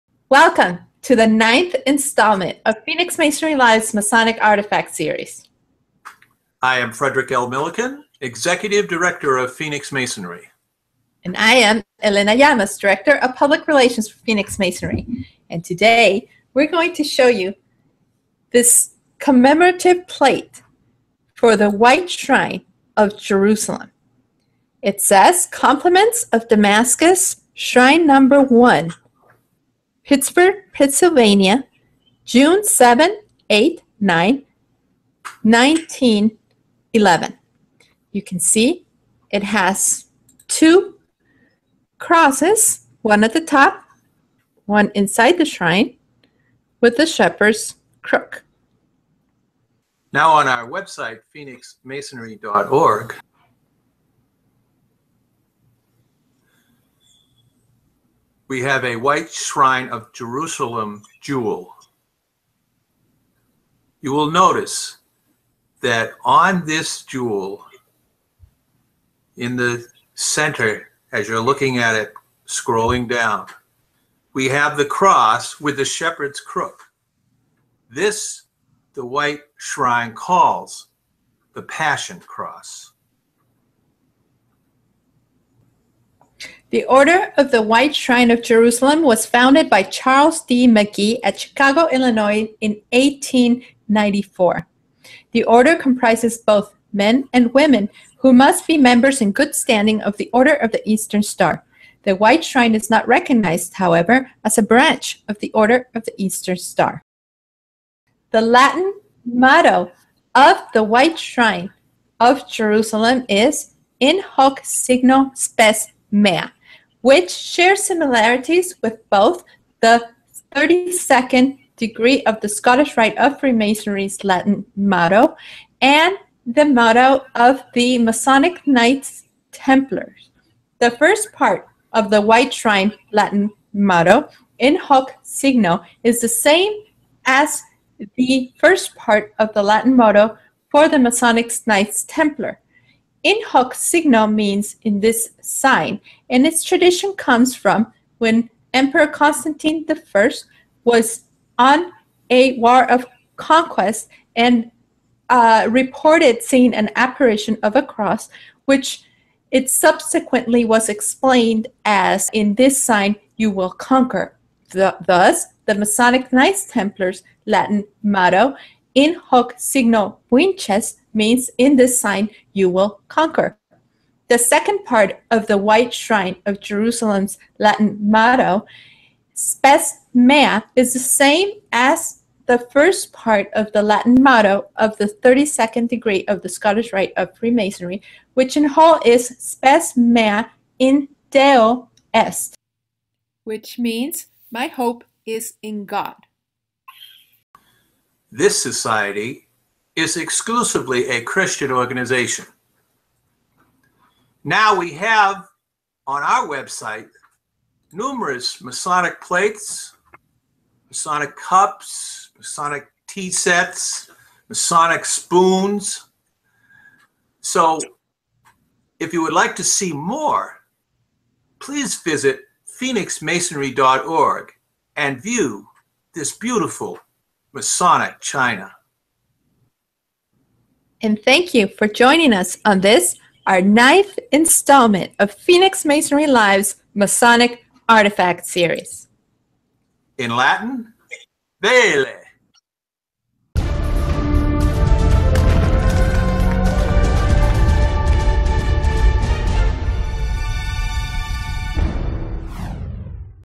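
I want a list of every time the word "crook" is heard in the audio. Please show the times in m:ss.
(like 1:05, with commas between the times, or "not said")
0:48, 1:16.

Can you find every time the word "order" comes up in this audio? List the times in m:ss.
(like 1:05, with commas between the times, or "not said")
1:26, 1:35, 1:40, 1:45.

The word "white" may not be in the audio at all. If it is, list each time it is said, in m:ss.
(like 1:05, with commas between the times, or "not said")
0:21, 0:58, 1:19, 1:27, 1:42, 1:50, 2:12, 2:55.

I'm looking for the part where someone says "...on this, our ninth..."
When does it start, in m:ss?
3:52.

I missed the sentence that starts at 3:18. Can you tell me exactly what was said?
This society is exclusively a Christian organization.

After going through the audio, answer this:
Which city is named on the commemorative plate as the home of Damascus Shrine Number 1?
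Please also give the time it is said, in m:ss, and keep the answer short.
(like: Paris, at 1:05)
Pittsburgh, at 0:30.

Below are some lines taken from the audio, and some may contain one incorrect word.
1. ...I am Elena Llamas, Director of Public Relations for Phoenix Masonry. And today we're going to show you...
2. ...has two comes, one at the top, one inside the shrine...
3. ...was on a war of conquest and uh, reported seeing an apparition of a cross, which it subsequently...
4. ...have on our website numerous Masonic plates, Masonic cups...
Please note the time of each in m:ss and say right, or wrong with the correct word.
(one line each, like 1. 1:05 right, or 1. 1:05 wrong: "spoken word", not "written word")
1. 0:11 right
2. 0:39 wrong: "crosses", not "comes"
3. 2:30 right
4. 3:24 right.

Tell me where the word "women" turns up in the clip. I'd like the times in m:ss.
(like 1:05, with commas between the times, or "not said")
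1:37.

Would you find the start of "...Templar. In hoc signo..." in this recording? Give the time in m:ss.
2:22.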